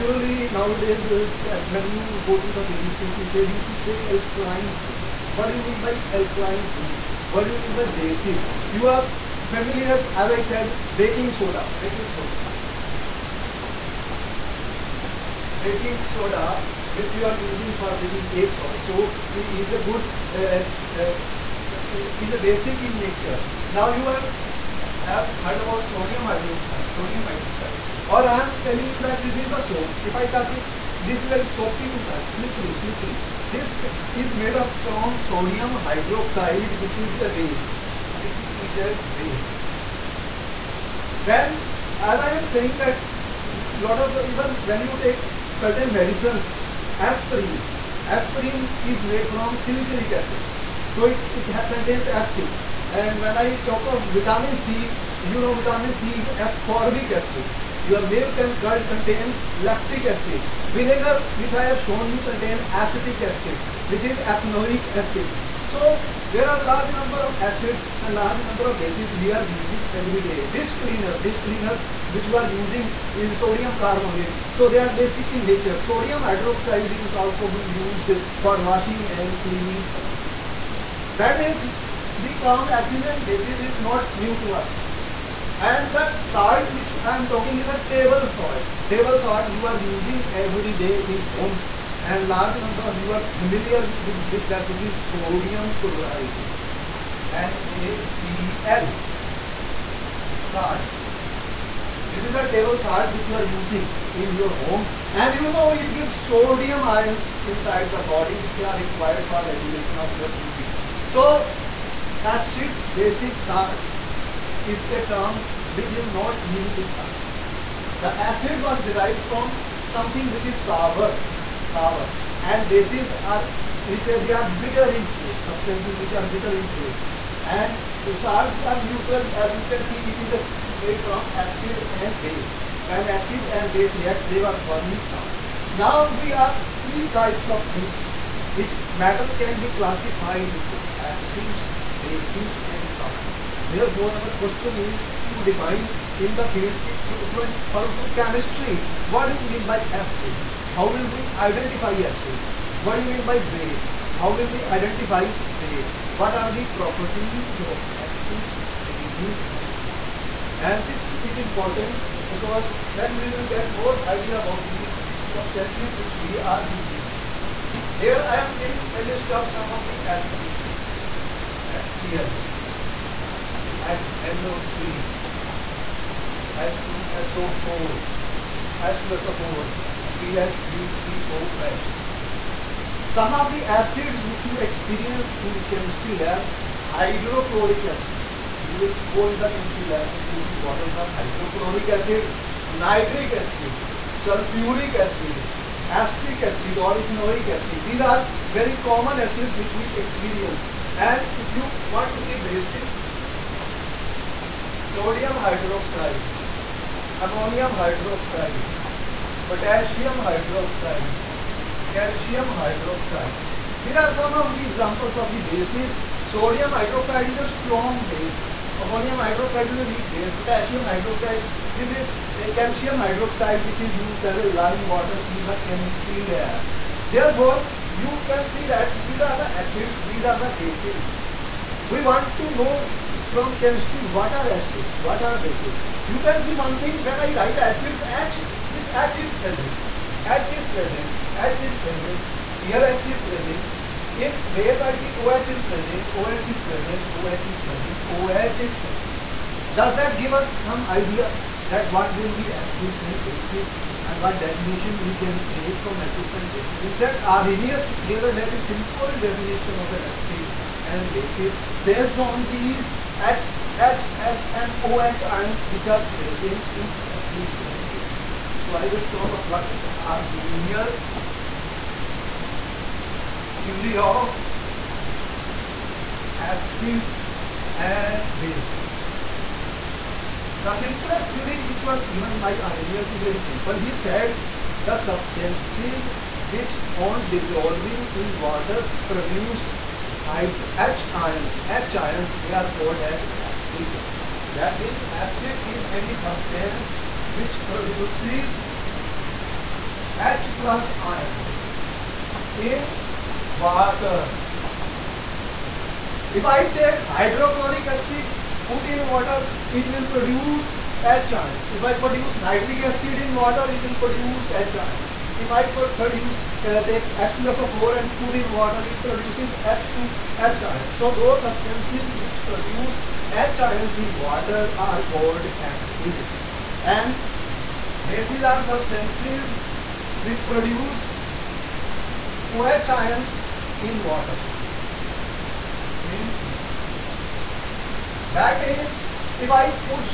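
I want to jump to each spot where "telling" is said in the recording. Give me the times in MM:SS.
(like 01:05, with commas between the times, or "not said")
00:28.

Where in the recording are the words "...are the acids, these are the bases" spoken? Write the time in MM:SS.
03:49.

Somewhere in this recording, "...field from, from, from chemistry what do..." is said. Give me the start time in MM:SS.
02:26.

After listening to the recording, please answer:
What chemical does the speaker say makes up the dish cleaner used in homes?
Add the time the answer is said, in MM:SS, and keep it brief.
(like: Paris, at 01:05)
sodium carbonate, at 01:13.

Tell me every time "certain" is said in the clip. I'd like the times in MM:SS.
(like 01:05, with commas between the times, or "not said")
00:45.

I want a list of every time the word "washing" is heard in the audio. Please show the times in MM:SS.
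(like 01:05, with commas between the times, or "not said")
01:18.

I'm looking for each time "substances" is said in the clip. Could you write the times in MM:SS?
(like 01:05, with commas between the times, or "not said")
02:05, 02:45, 04:44, 04:56, 05:21, 05:28.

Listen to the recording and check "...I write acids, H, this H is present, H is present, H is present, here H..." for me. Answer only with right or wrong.
right.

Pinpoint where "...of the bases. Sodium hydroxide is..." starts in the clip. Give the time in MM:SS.
03:35.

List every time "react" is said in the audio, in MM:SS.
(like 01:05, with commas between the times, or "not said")
02:14.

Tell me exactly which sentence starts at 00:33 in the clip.
This is made up from sodium hydroxide, which is a base which is a base.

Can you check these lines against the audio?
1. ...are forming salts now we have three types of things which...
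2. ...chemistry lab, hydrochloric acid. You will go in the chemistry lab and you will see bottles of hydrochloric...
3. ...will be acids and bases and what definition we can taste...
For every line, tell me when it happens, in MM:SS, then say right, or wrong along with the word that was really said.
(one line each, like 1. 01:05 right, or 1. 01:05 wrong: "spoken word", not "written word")
1. 02:14 right
2. 03:05 right
3. 04:12 wrong: "create", not "taste".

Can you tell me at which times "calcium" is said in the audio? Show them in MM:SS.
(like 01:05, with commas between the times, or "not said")
03:31, 03:42.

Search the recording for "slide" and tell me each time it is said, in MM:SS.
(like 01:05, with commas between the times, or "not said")
not said.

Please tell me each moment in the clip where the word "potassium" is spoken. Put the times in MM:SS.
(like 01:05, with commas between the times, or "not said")
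03:29, 03:40.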